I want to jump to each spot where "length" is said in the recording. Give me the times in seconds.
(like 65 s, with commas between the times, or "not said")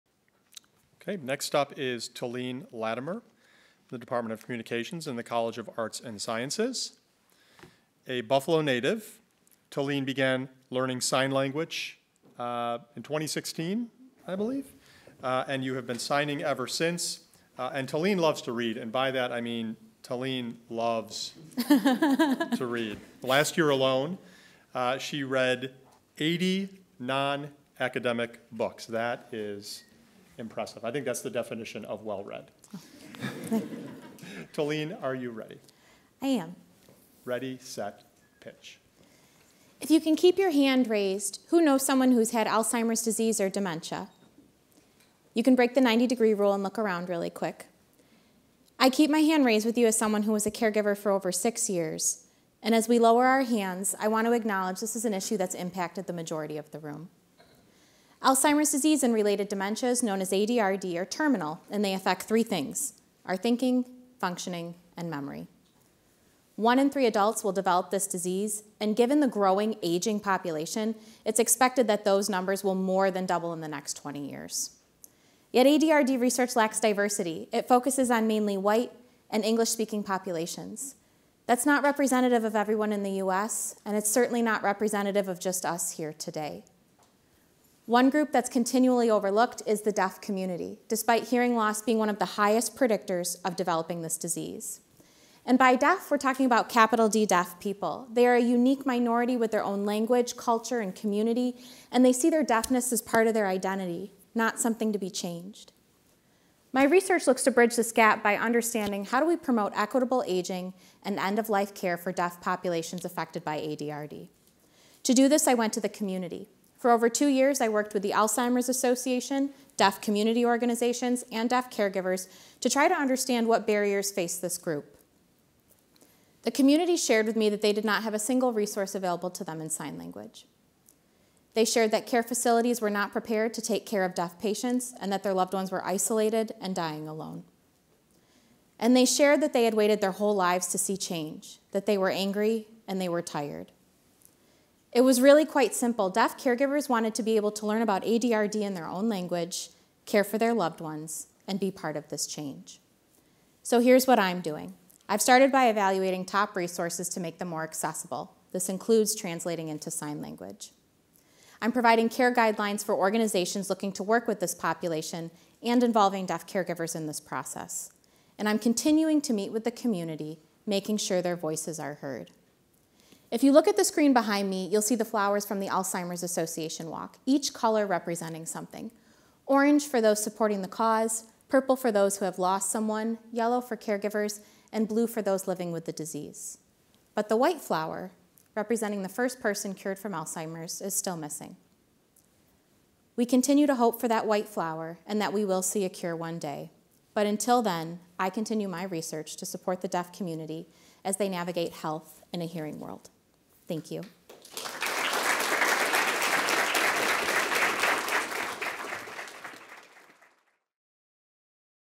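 not said.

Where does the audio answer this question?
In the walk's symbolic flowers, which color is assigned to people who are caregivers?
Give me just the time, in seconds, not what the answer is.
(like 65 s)
183 s.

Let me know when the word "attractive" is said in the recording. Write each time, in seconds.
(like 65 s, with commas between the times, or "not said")
not said.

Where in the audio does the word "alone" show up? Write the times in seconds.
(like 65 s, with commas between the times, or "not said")
23 s, 137 s.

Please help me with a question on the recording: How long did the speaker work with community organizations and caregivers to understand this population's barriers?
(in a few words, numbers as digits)
over two years.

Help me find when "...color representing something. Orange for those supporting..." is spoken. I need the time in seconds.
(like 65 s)
177 s.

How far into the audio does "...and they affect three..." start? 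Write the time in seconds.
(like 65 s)
61 s.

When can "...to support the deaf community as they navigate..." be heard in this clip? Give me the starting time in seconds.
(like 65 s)
199 s.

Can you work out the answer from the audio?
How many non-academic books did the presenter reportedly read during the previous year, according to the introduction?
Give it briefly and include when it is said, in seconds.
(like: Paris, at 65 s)
80, at 26 s.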